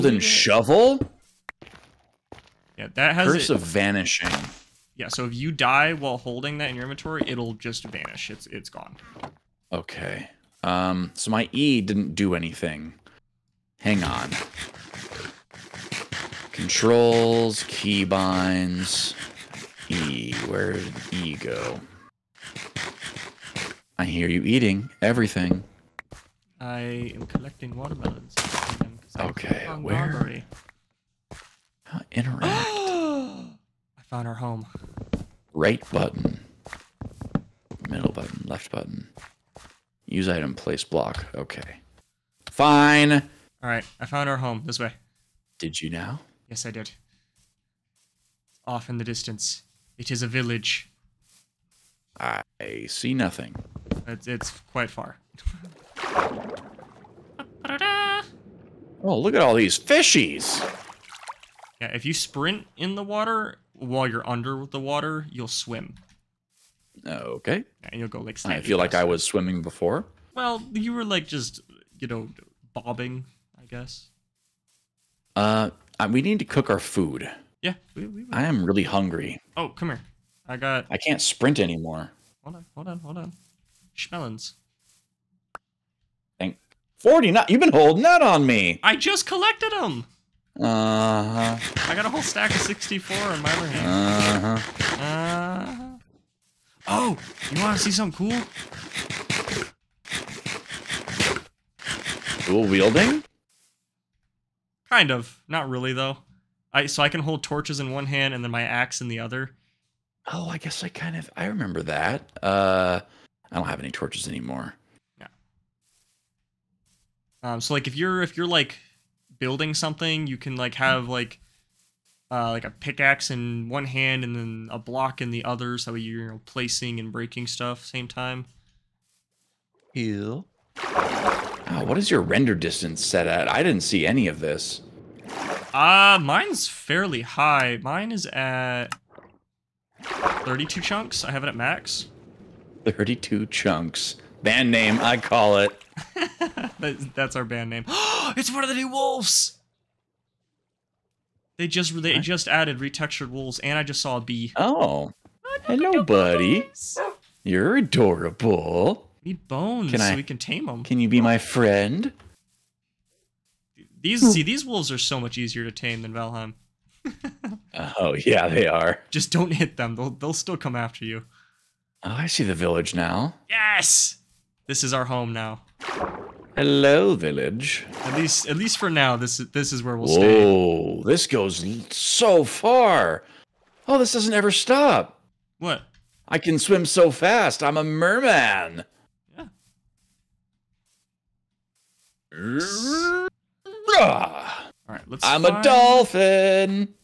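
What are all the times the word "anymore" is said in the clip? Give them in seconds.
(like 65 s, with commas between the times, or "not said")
81 s, 114 s.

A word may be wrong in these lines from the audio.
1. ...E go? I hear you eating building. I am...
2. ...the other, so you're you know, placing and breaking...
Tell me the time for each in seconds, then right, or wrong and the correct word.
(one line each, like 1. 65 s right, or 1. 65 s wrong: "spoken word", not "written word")
1. 21 s wrong: "everything", not "building"
2. 125 s right.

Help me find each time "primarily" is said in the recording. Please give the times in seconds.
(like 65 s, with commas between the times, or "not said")
not said.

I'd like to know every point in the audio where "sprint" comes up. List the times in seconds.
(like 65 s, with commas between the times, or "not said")
62 s, 81 s.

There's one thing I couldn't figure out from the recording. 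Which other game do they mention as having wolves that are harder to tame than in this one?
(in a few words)
Valheim.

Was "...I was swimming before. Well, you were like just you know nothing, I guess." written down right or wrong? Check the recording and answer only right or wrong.
wrong.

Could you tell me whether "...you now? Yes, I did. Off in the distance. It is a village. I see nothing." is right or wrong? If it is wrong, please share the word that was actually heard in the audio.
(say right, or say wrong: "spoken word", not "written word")
right.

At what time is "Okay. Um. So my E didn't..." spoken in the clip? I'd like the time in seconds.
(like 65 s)
9 s.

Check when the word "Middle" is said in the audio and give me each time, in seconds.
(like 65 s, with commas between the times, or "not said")
37 s.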